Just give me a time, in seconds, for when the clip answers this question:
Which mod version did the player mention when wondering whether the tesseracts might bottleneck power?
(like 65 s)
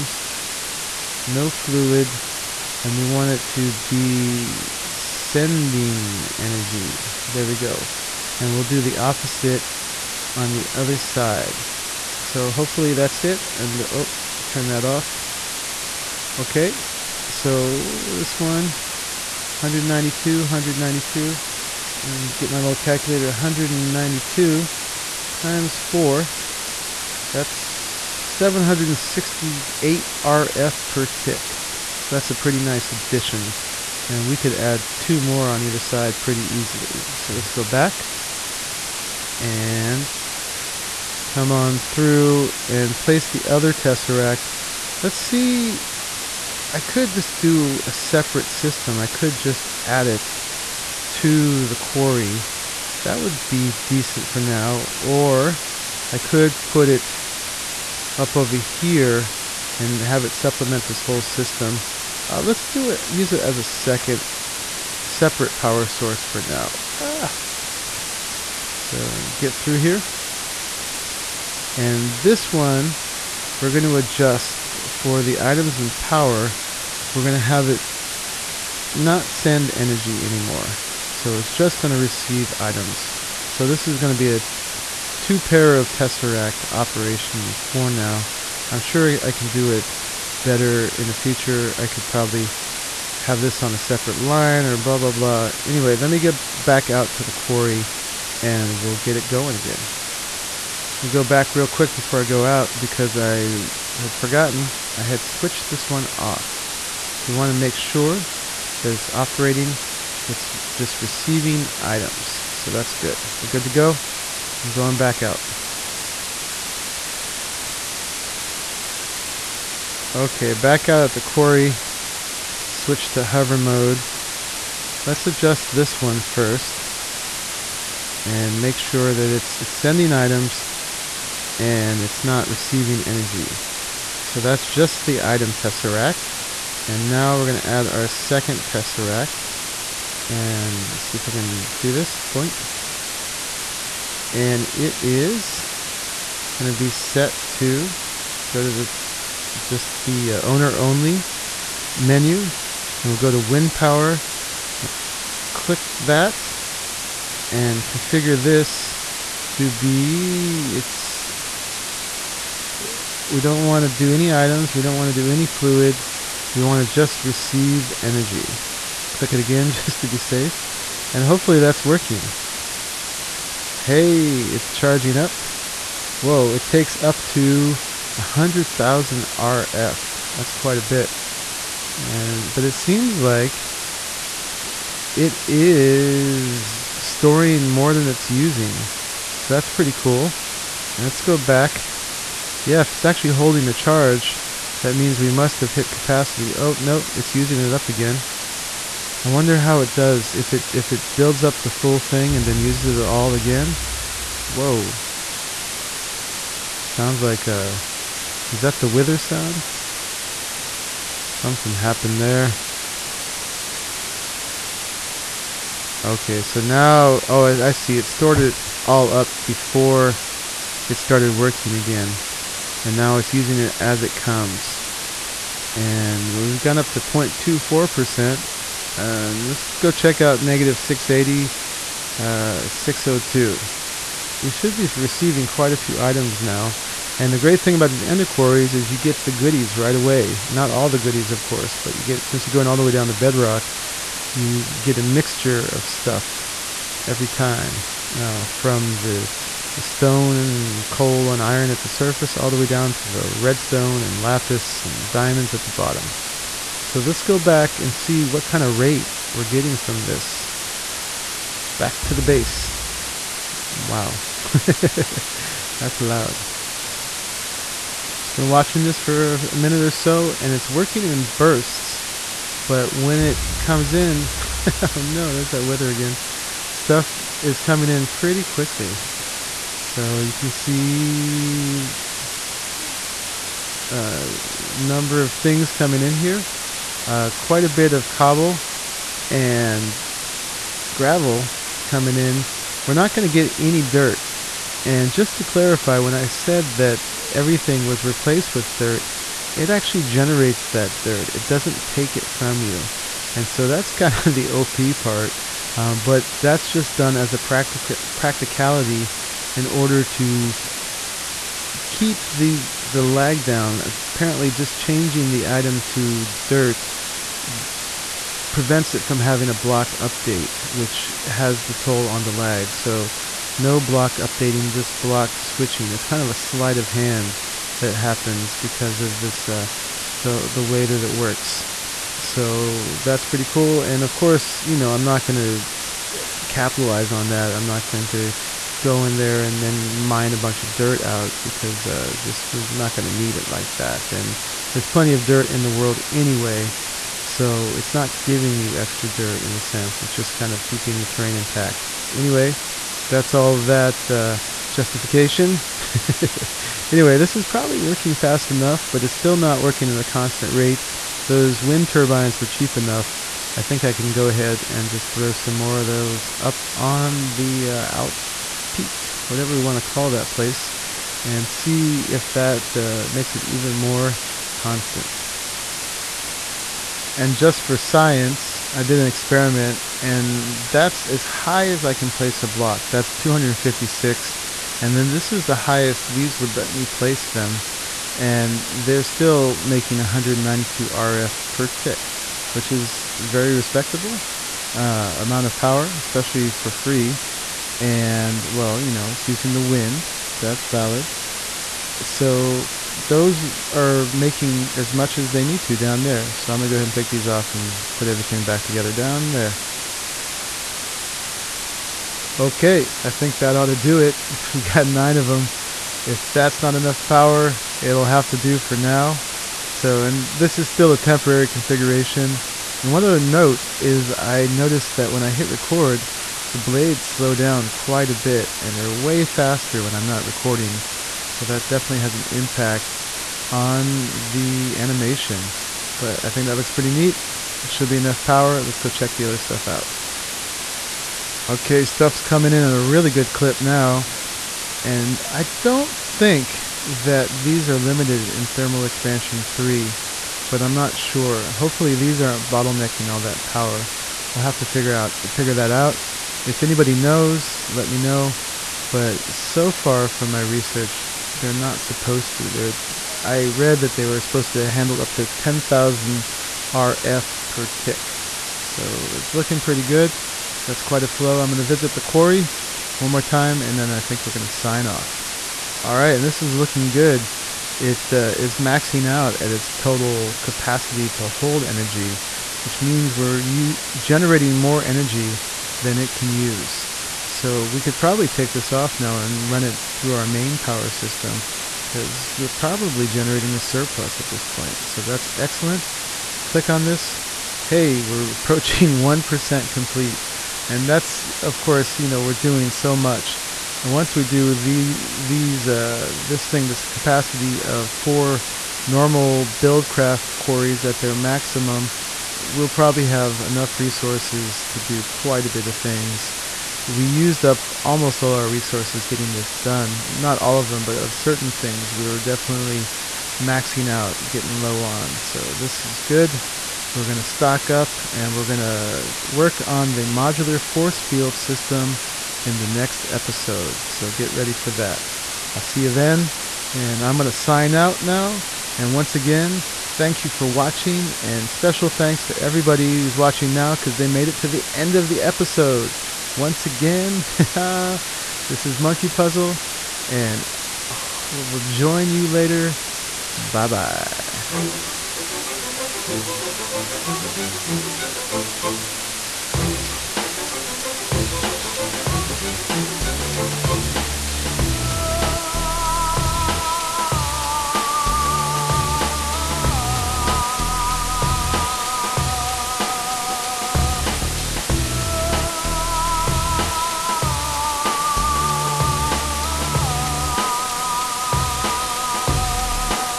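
448 s.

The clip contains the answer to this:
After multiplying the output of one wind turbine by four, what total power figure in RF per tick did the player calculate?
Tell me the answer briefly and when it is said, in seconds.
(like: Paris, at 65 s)
768, at 27 s.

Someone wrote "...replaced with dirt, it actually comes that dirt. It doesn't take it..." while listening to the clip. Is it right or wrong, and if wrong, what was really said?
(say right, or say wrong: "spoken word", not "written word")
wrong: "generates", not "comes".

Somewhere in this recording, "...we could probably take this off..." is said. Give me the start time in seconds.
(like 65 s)
487 s.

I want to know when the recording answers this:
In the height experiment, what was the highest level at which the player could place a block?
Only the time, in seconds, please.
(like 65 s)
383 s.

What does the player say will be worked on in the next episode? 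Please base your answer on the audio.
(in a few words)
modular force field system.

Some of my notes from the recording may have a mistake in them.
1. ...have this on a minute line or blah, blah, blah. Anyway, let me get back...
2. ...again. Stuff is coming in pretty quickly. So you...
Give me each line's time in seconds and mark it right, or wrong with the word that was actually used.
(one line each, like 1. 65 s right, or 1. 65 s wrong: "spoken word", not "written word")
1. 93 s wrong: "separate", not "minute"
2. 275 s right.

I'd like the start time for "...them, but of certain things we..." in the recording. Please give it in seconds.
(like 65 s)
520 s.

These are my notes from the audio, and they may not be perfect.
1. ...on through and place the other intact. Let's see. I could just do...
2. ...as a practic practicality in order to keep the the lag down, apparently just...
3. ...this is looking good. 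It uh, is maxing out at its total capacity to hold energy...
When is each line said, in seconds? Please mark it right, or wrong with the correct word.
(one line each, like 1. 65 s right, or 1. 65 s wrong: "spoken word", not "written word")
1. 41 s wrong: "tesseract", not "intact"
2. 307 s right
3. 476 s right.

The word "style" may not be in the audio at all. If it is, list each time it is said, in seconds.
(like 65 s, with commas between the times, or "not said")
not said.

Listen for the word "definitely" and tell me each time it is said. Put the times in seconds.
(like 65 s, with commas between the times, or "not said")
431 s, 522 s.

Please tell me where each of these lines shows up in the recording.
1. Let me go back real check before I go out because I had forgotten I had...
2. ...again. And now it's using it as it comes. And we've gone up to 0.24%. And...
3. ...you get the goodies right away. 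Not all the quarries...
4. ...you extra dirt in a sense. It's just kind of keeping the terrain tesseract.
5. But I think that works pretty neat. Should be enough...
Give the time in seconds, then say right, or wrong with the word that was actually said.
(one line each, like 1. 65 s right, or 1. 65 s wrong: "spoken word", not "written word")
1. 101 s wrong: "quick", not "check"
2. 221 s right
3. 238 s wrong: "goodies", not "quarries"
4. 348 s wrong: "intact", not "tesseract"
5. 435 s wrong: "looks", not "works".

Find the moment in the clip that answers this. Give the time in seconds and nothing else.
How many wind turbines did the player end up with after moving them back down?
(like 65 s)
414 s.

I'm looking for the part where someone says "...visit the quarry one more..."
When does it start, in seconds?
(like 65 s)
471 s.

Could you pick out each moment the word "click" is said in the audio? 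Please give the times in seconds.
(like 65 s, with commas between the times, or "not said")
155 s, 169 s, 496 s.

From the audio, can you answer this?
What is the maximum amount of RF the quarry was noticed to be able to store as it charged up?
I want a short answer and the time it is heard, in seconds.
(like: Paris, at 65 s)
100,000, at 178 s.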